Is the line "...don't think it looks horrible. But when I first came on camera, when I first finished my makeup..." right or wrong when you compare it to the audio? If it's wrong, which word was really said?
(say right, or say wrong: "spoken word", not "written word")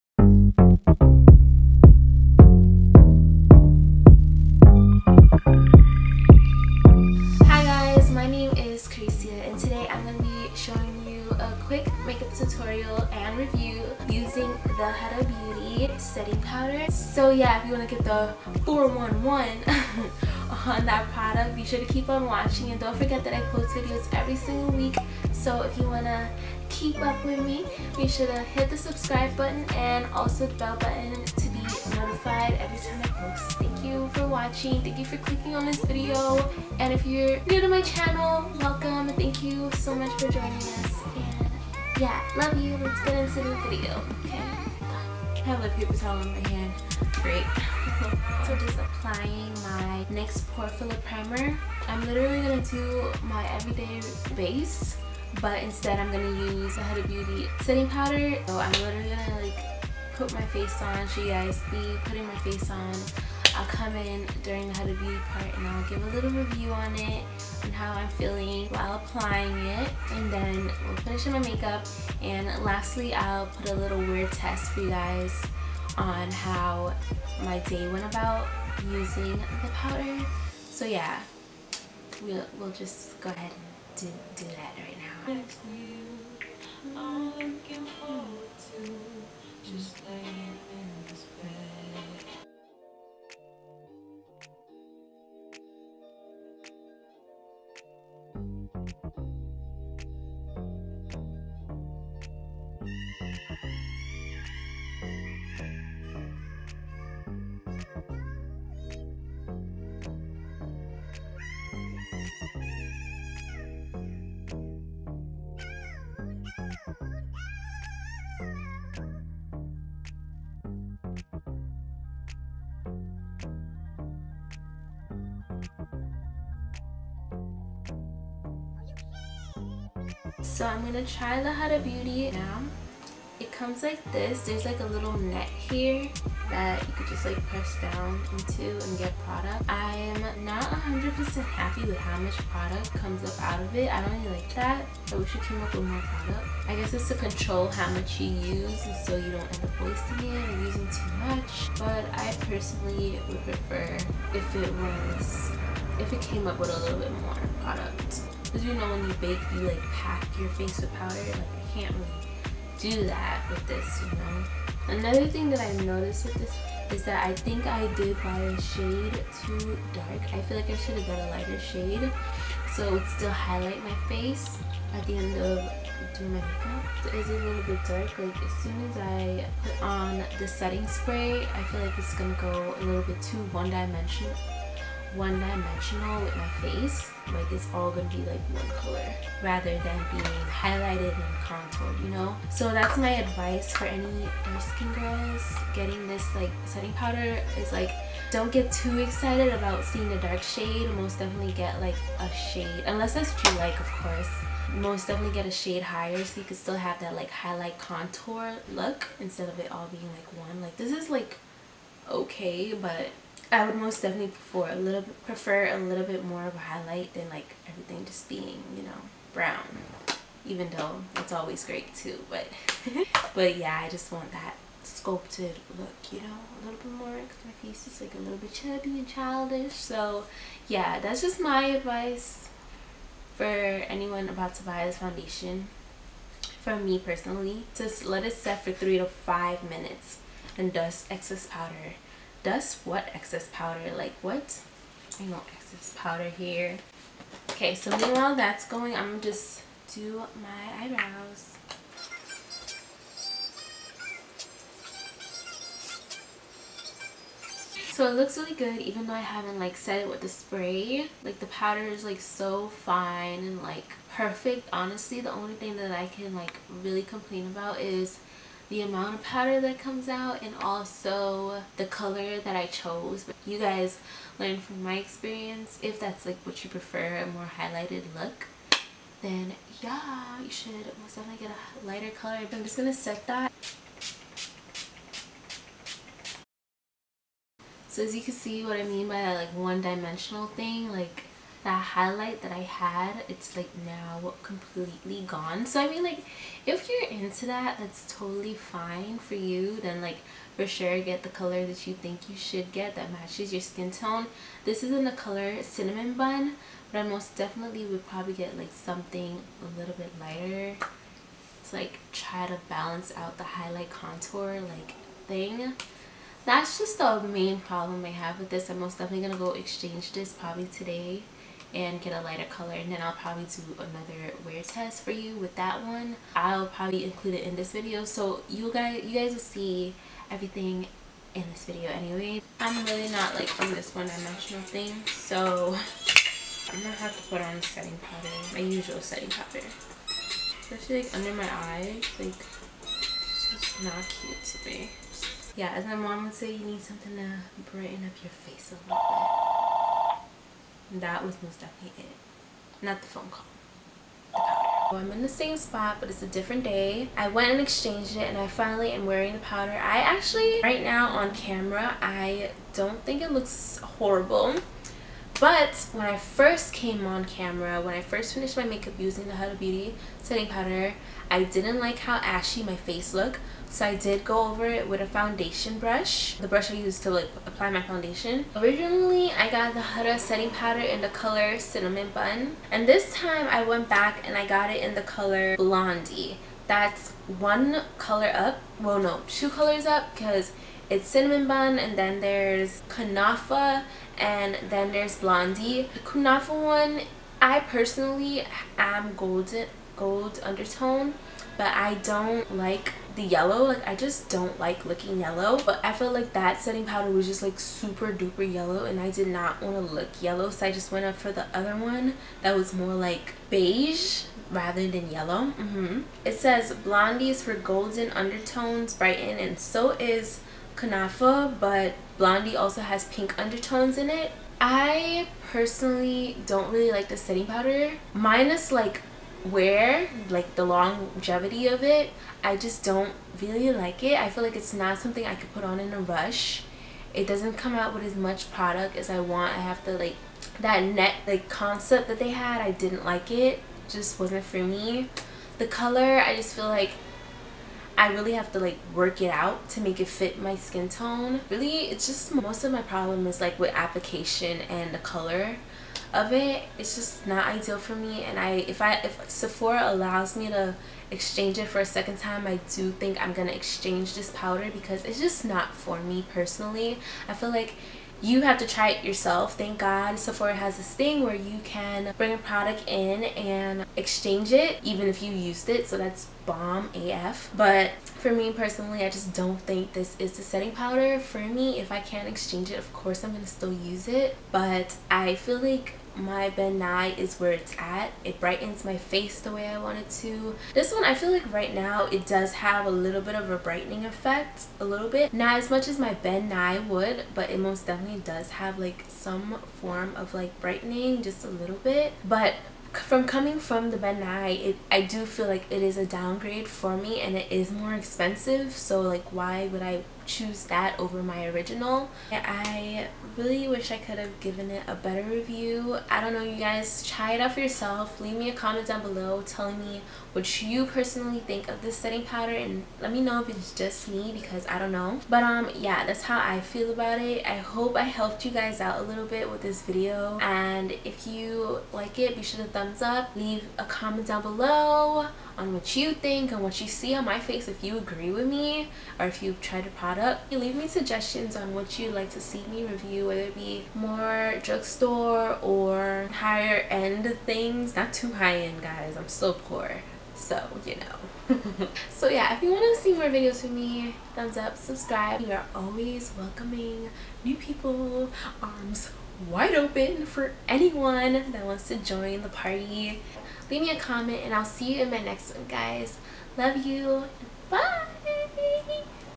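right.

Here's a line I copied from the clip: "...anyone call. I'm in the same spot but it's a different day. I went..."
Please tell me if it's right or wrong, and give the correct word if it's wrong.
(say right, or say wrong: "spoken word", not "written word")
wrong: "phone", not "anyone".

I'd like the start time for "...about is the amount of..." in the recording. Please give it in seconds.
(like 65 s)
267 s.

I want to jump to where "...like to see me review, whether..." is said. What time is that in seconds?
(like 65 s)
542 s.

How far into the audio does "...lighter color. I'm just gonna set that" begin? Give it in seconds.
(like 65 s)
281 s.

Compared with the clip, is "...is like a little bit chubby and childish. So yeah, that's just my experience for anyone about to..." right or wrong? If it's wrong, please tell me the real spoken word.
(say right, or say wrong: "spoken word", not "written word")
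wrong: "advice", not "experience".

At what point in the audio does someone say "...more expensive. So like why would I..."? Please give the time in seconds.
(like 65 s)
507 s.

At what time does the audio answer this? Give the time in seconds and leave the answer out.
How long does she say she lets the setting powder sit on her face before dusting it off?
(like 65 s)
238 s.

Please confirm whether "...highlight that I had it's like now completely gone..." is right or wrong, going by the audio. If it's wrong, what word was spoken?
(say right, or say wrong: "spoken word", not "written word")
right.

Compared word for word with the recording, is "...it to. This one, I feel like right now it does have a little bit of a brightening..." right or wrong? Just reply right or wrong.
right.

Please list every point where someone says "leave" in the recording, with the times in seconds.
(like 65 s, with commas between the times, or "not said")
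518 s, 533 s, 540 s, 563 s.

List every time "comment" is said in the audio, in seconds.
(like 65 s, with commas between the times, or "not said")
518 s, 533 s, 563 s.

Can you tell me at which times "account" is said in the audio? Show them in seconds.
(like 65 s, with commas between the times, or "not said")
not said.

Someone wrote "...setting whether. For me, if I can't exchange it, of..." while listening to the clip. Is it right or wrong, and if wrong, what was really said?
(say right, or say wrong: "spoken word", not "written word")
wrong: "powder", not "whether".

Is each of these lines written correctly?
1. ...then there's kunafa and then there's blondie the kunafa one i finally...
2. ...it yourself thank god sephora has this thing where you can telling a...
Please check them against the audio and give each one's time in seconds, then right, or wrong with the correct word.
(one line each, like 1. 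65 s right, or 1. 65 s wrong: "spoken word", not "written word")
1. 391 s wrong: "personally", not "finally"
2. 468 s wrong: "bring", not "telling".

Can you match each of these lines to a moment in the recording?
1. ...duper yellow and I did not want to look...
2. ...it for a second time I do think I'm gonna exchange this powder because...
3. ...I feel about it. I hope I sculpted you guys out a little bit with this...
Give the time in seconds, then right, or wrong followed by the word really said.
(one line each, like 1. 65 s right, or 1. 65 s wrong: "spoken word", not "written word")
1. 408 s right
2. 461 s right
3. 526 s wrong: "helped", not "sculpted".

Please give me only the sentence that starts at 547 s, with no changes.
Not too high end guys, I'm still poor.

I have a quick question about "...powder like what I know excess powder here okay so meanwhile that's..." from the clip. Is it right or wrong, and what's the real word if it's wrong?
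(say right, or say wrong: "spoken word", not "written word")
right.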